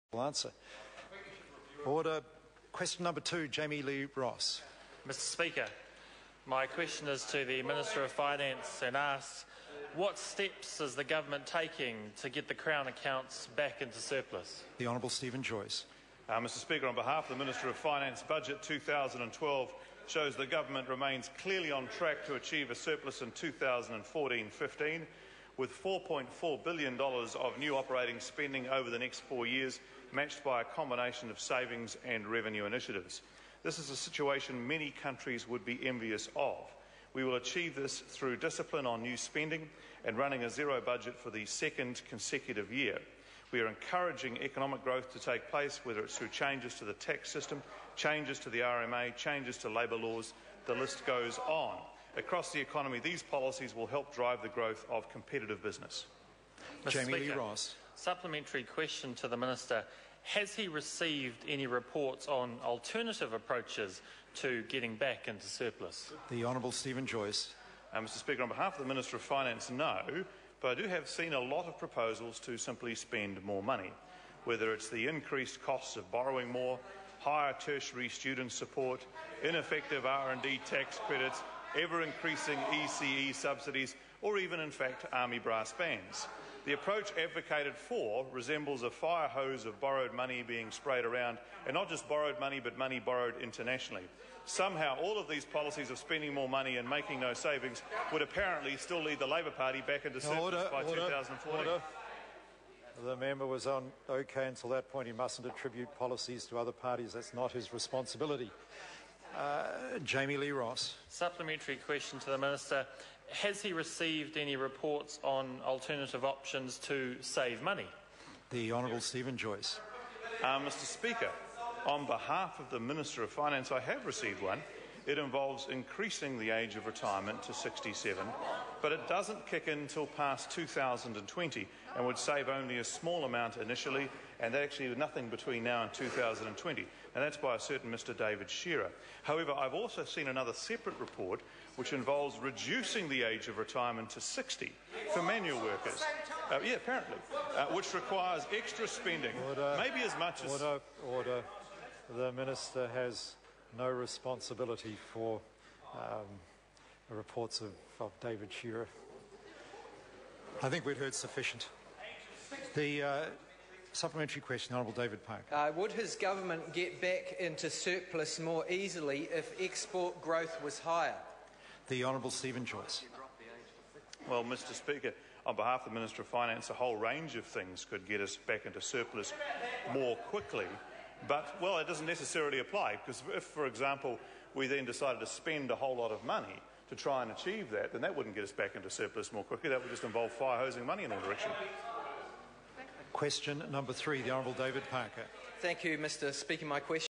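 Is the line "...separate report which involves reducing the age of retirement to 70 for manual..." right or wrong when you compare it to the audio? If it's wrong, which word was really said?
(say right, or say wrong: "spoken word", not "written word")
wrong: "60", not "70".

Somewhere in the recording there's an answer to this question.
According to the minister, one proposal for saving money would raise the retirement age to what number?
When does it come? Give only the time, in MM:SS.
02:07.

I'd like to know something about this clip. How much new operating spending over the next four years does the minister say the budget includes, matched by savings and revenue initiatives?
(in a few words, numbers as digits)
$4.4 billion.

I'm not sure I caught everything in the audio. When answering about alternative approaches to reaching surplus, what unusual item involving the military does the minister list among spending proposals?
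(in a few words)
army brass bands.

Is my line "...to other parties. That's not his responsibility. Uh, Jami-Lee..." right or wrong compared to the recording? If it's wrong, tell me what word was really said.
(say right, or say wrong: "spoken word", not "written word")
right.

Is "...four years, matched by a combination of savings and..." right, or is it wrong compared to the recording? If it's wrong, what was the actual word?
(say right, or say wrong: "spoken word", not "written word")
right.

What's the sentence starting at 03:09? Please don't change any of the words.
That would just involve fire hosing money in all directions.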